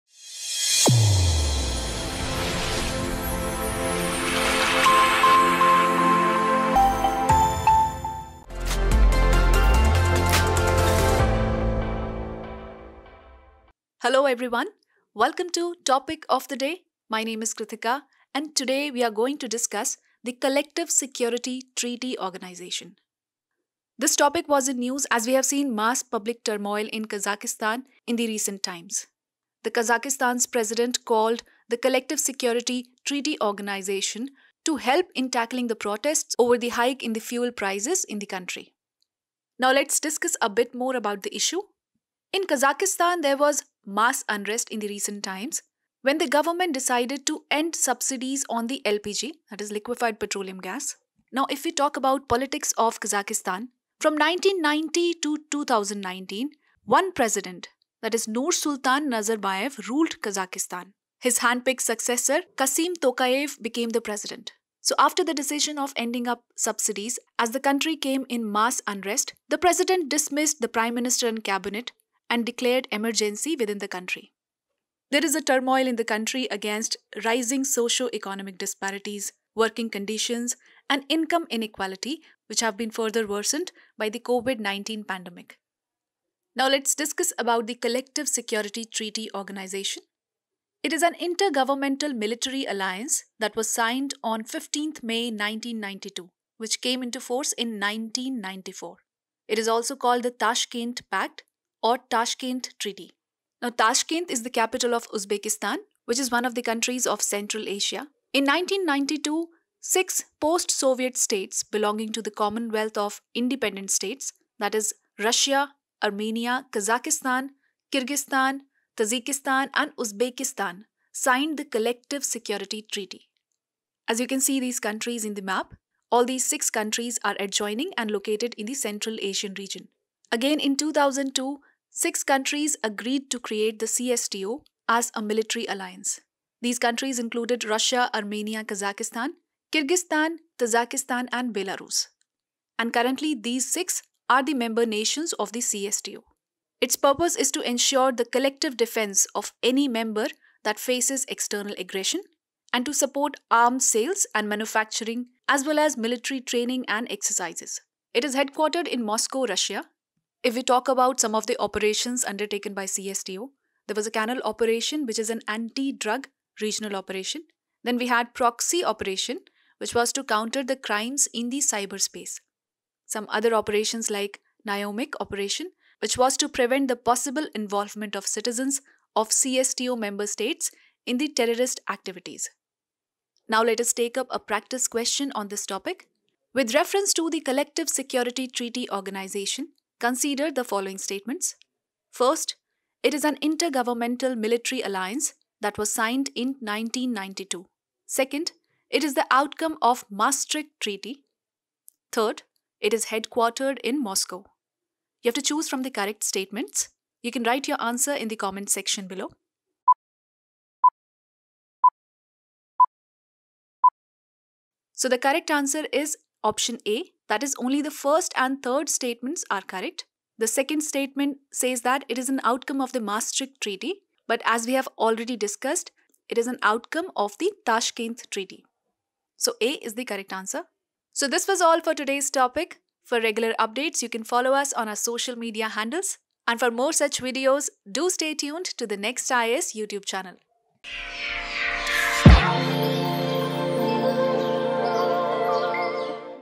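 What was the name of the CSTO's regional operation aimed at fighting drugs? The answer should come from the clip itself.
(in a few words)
Kanal operation.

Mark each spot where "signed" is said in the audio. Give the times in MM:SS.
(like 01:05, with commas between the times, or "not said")
01:33, 02:01, 03:15.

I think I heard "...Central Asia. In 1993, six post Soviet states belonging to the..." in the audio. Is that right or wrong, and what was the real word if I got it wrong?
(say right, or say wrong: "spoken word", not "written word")
wrong: "1992", not "1993".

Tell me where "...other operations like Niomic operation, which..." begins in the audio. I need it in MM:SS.
02:53.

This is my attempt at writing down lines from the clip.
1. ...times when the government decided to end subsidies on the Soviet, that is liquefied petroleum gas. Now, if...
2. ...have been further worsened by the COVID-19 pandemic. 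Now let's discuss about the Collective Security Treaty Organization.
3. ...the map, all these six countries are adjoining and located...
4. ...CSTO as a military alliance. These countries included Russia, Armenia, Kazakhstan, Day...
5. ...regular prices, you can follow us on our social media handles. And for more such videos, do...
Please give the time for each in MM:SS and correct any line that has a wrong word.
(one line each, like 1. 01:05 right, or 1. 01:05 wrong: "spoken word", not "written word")
1. 00:45 wrong: "LPG", not "Soviet"
2. 01:22 right
3. 02:05 right
4. 02:13 wrong: "Kyrgyzstan", not "Day"
5. 03:53 wrong: "updates", not "prices".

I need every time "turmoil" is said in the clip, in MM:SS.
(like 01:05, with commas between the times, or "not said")
00:26, 01:15.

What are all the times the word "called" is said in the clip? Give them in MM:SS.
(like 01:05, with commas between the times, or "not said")
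00:31, 01:39.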